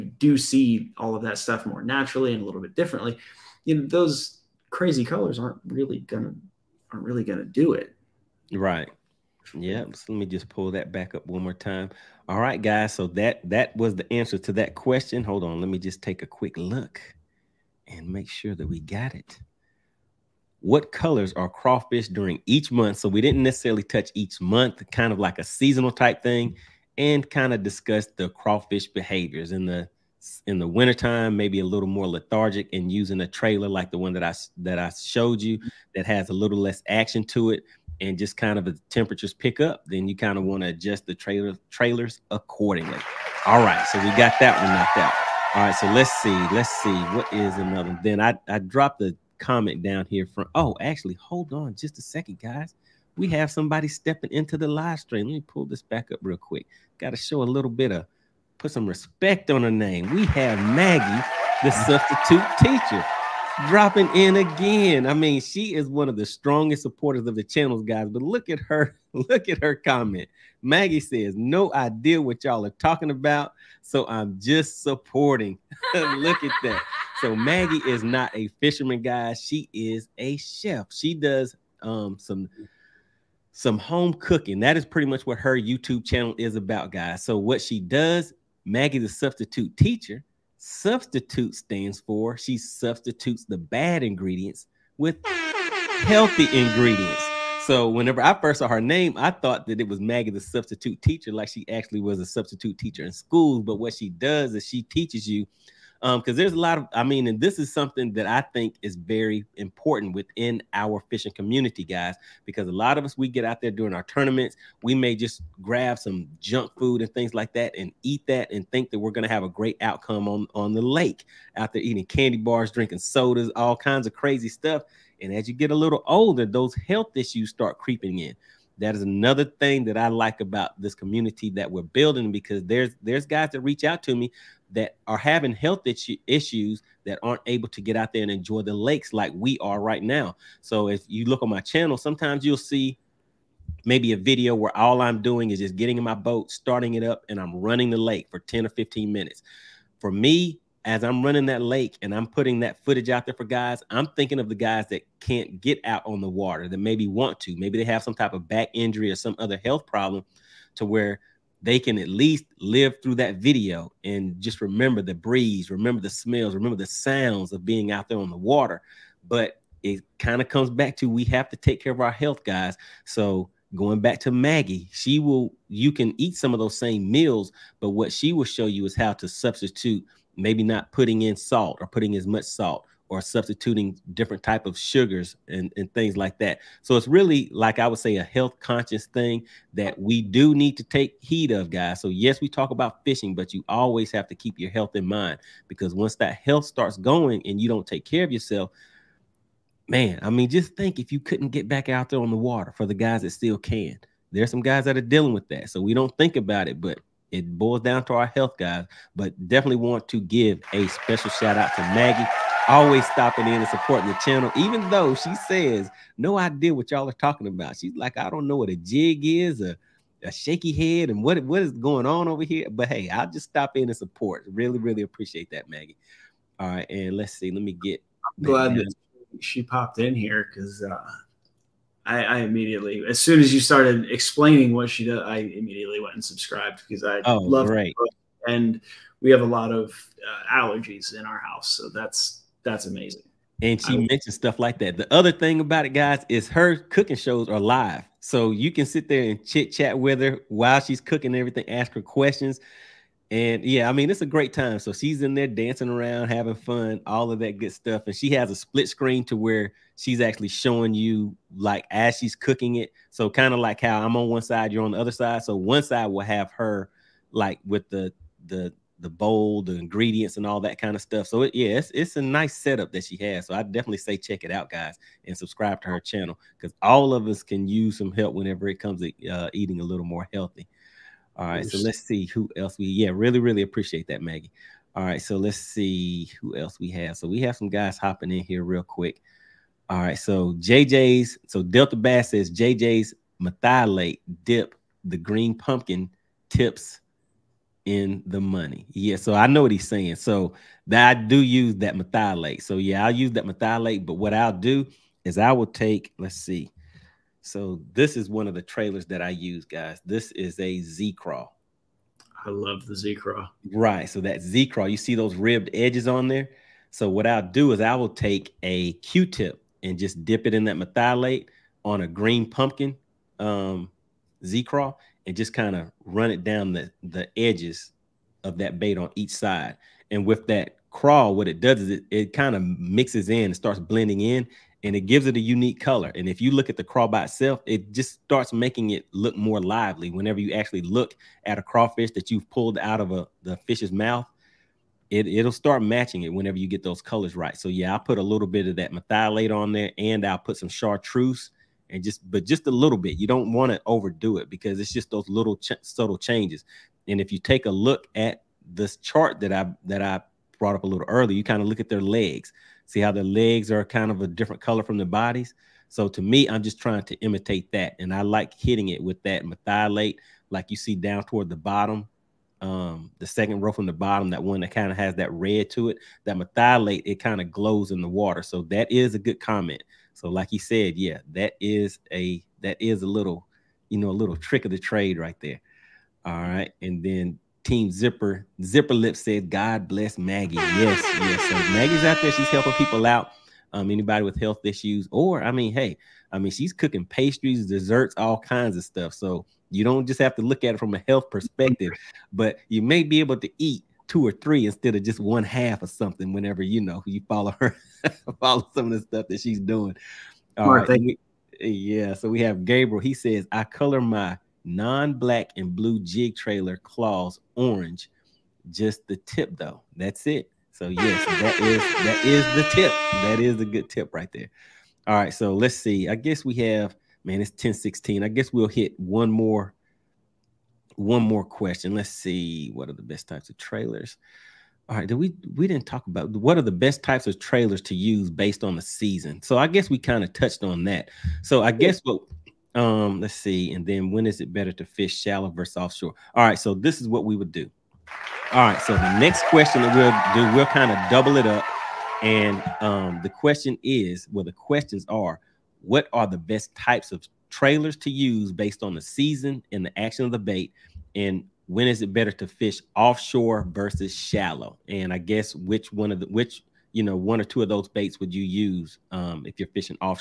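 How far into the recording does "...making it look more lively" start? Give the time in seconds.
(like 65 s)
338 s.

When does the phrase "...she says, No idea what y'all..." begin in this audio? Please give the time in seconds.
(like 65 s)
215 s.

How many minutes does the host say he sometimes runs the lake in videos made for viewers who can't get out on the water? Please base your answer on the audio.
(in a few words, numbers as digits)
10 or 15 minutes.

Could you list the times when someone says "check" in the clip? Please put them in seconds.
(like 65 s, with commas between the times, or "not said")
274 s.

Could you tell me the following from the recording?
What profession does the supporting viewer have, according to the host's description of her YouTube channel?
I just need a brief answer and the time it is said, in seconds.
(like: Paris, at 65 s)
Chef, at 79 s.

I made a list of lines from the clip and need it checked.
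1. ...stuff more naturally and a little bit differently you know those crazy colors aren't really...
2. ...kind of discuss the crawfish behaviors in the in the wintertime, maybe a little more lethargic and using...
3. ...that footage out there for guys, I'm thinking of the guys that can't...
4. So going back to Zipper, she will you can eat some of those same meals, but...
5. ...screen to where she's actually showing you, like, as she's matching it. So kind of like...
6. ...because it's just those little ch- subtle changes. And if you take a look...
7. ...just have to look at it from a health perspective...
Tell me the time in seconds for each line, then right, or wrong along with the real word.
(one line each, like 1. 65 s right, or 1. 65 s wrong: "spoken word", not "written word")
1. 1 s right
2. 27 s right
3. 152 s right
4. 173 s wrong: "Maggie", not "Zipper"
5. 258 s wrong: "cooking", not "matching"
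6. 354 s right
7. 400 s right.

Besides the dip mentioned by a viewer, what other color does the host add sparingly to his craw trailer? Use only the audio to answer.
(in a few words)
Chartreuse.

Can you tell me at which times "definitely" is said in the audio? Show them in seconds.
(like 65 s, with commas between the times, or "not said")
209 s, 273 s.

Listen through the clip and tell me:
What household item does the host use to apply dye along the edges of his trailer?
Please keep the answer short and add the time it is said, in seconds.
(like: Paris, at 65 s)
Q-tip, at 318 s.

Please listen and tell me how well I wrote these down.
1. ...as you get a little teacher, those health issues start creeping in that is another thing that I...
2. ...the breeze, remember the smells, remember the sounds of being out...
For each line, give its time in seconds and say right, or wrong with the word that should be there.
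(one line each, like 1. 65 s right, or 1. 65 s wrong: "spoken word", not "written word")
1. 125 s wrong: "older", not "teacher"
2. 165 s right.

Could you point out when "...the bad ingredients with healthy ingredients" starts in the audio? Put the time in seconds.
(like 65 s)
93 s.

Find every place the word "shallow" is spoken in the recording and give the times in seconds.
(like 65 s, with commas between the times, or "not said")
445 s, 464 s.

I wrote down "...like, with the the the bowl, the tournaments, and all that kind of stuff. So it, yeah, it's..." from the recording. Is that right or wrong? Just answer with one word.
wrong.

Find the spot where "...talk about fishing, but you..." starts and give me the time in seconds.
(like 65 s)
192 s.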